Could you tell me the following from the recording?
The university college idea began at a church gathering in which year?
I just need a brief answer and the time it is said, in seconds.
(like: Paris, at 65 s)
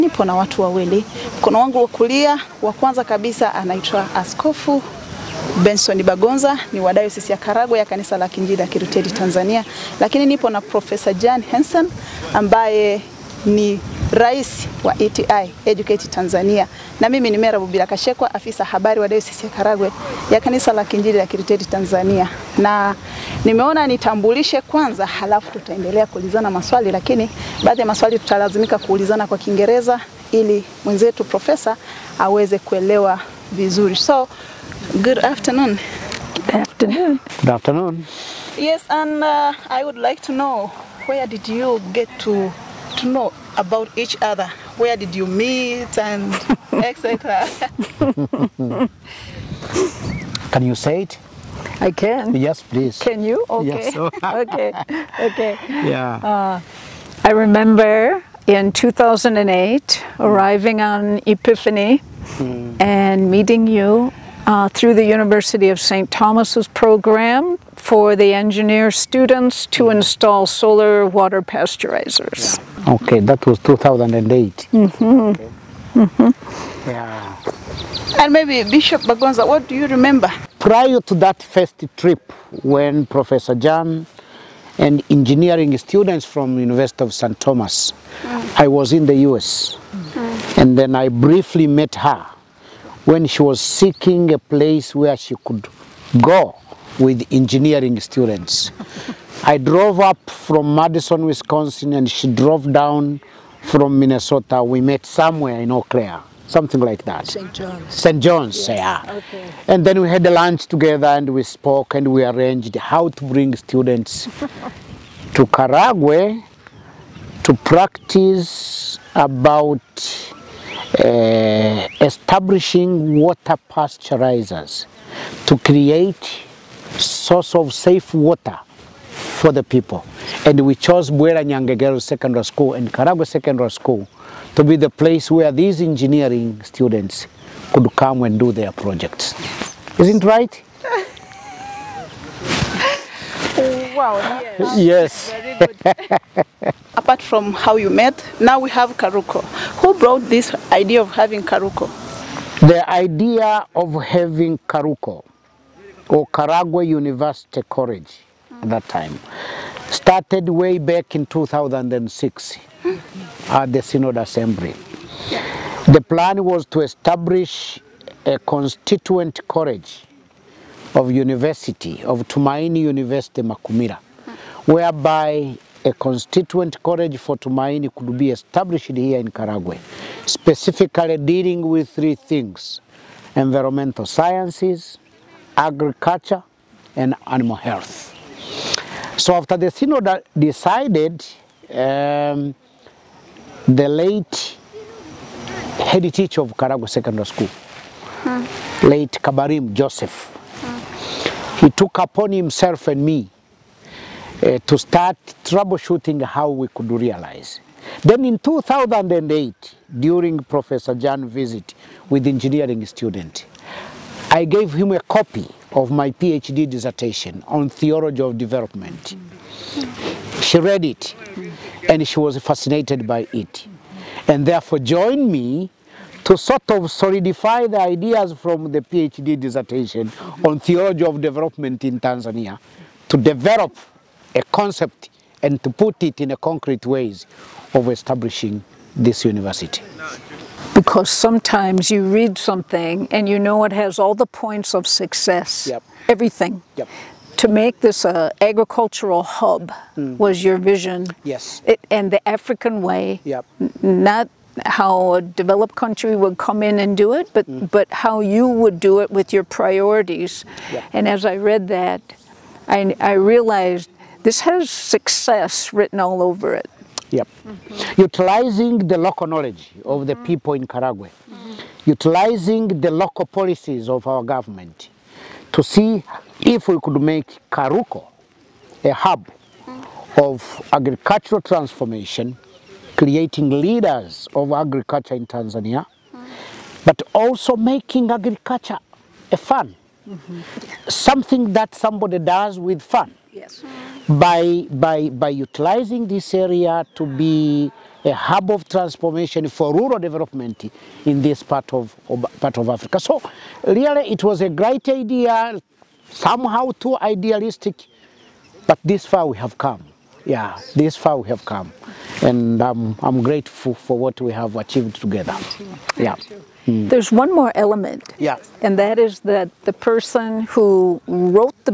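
2006, at 161 s.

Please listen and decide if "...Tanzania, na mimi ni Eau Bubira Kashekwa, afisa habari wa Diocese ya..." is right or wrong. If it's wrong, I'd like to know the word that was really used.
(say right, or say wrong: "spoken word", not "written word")
wrong: "Mera", not "Eau".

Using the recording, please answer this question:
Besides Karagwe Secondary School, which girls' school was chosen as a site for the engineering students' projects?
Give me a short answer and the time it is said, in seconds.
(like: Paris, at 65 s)
Bwera Girls Secondary School, at 131 s.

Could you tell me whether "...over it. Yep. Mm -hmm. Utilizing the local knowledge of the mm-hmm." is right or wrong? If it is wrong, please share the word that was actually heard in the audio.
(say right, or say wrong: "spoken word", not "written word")
right.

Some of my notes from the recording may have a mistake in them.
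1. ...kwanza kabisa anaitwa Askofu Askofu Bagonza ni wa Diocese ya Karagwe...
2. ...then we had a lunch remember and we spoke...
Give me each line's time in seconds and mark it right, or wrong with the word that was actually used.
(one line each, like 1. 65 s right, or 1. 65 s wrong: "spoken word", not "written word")
1. 2 s wrong: "Benson", not "Askofu"
2. 109 s wrong: "together", not "remember".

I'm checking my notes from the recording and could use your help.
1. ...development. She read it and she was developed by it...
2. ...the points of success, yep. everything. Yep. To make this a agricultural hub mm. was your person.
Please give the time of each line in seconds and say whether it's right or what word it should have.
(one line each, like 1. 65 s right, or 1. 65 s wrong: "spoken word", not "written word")
1. 218 s wrong: "fascinated", not "developed"
2. 244 s wrong: "vision", not "person".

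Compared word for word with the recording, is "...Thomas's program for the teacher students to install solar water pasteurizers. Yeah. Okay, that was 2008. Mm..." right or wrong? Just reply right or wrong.
wrong.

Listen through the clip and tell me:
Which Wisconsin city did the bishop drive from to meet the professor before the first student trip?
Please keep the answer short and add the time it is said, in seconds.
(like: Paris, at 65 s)
Madison, at 100 s.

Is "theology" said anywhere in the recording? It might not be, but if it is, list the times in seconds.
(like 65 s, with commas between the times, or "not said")
217 s, 230 s.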